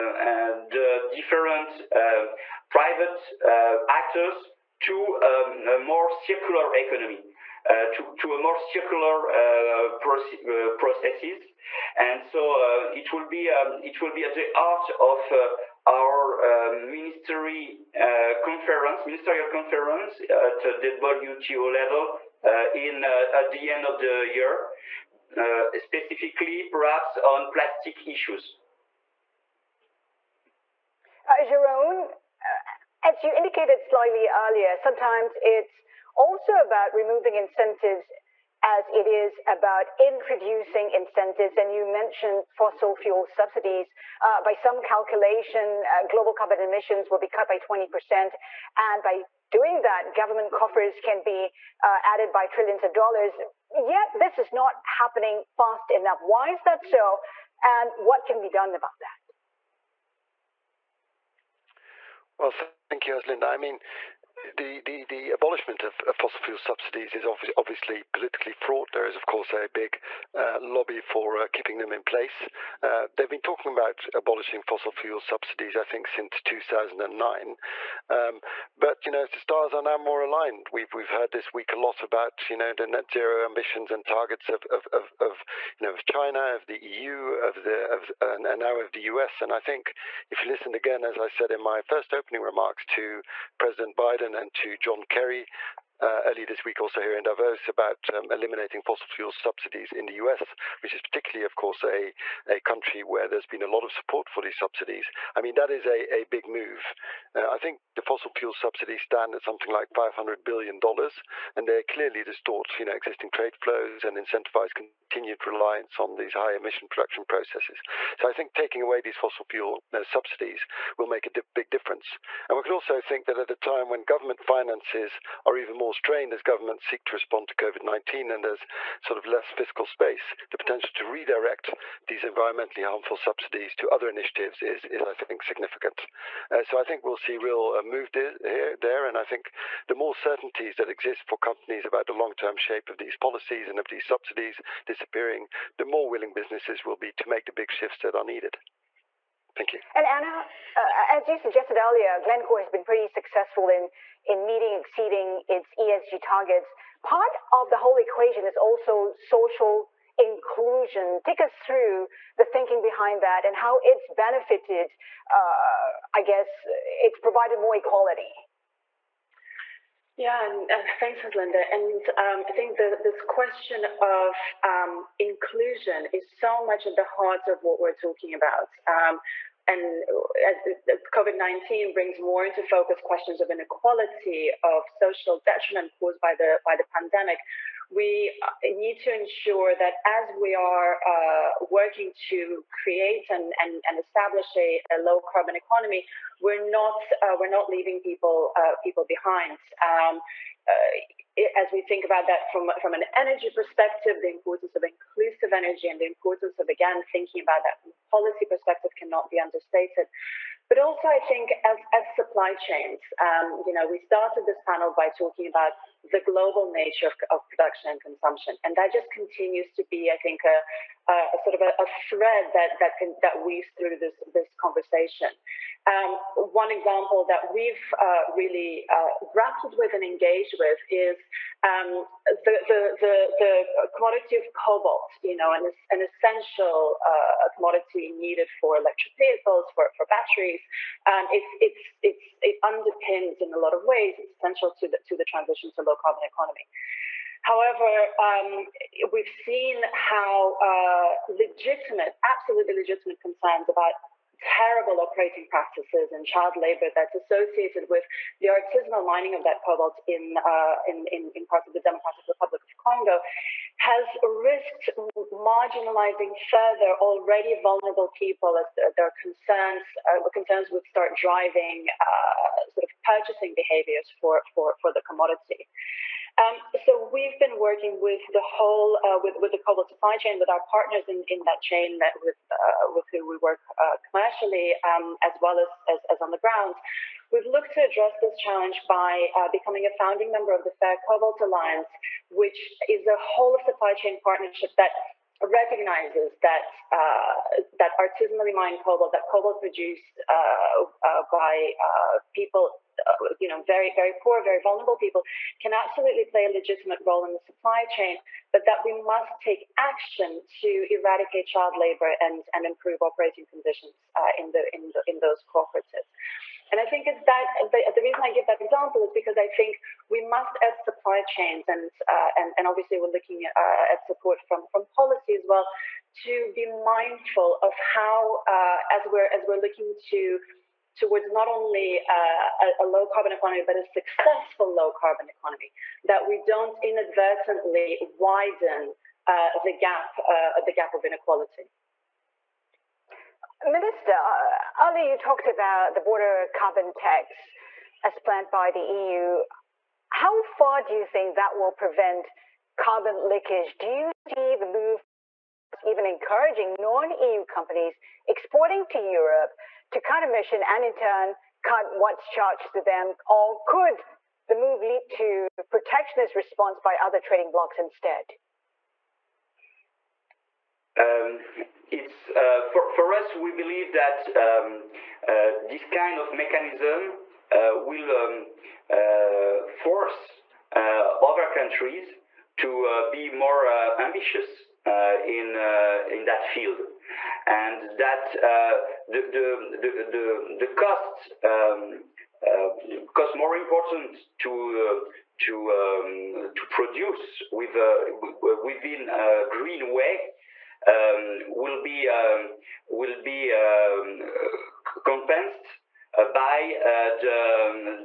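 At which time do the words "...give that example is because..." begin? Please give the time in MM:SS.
05:18.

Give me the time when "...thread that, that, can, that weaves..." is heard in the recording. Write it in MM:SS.
03:41.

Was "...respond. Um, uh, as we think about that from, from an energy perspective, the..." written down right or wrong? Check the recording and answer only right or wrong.
wrong.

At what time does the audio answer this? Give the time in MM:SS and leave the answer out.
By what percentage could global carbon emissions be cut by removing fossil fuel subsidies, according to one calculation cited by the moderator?
00:47.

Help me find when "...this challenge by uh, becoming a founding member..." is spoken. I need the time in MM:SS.
04:48.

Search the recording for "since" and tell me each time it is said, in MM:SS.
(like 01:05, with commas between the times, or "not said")
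01:16.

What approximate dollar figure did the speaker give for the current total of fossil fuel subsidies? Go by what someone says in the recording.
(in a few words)
$500 billion.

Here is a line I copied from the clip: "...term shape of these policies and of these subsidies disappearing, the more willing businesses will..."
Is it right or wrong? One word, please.
right.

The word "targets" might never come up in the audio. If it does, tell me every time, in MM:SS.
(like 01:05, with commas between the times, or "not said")
01:24, 02:36.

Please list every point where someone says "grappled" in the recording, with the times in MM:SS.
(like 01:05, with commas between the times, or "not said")
03:49.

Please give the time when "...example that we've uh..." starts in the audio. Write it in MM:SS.
03:46.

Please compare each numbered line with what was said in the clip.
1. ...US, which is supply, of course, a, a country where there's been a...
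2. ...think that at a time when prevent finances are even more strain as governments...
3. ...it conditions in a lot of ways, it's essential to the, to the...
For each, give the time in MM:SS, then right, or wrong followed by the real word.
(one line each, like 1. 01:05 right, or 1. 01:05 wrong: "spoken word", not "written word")
1. 01:40 wrong: "particularly", not "supply"
2. 02:03 wrong: "government", not "prevent"
3. 04:02 wrong: "underpins", not "conditions".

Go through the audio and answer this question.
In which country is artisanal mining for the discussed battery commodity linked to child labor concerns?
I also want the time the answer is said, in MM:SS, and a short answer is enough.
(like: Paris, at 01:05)
Democratic Republic of Congo, at 04:21.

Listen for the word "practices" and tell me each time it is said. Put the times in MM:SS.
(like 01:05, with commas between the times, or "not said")
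04:15.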